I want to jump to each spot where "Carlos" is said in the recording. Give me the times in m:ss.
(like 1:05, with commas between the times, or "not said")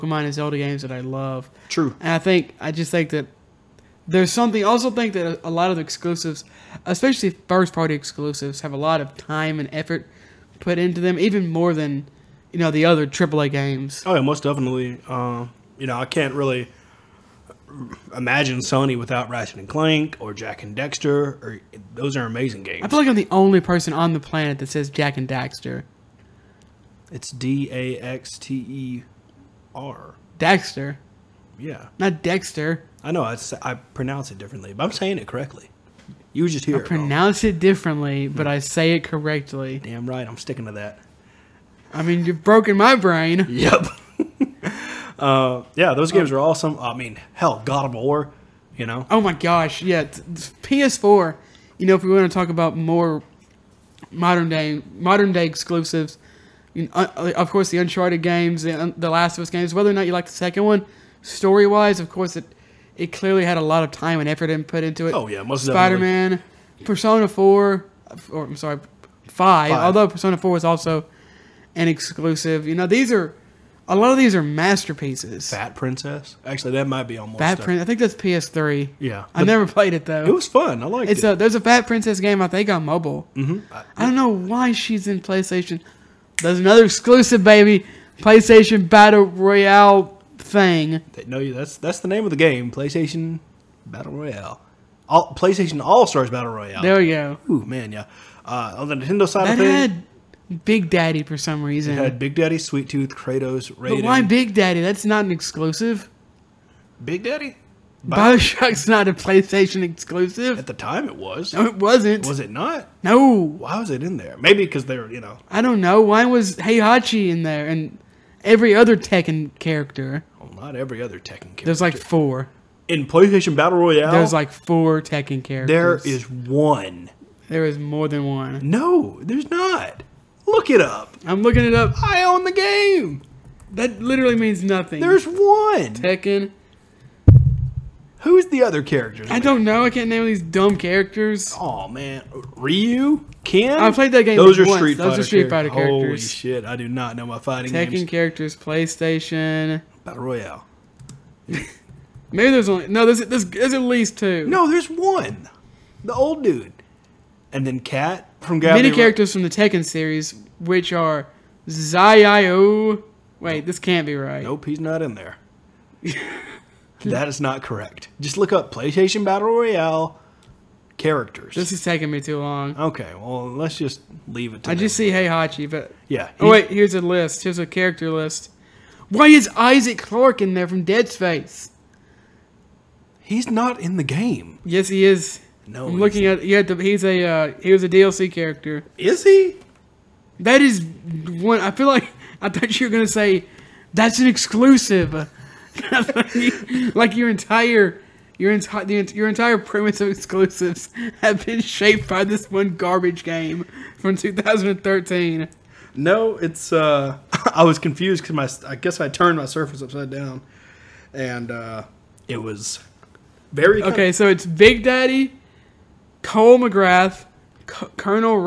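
not said.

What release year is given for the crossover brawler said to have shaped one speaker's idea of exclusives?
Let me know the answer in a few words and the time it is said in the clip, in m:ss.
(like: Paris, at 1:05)
2013, at 3:24.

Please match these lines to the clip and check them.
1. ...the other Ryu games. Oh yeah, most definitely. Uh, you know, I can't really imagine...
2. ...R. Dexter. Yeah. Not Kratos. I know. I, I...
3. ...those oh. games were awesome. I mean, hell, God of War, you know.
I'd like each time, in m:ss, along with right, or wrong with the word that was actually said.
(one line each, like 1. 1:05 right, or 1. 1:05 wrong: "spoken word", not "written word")
1. 0:12 wrong: "AAA", not "Ryu"
2. 0:29 wrong: "Dexter", not "Kratos"
3. 0:45 right.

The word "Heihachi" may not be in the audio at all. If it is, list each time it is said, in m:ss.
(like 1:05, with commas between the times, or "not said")
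1:56, 2:55.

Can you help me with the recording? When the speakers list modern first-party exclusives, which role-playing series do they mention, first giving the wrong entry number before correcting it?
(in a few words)
Persona 5.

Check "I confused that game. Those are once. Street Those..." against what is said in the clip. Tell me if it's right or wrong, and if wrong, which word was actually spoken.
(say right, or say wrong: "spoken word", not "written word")
wrong: "played", not "confused".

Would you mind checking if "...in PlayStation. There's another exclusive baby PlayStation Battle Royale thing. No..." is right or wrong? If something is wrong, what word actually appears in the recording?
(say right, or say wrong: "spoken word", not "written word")
right.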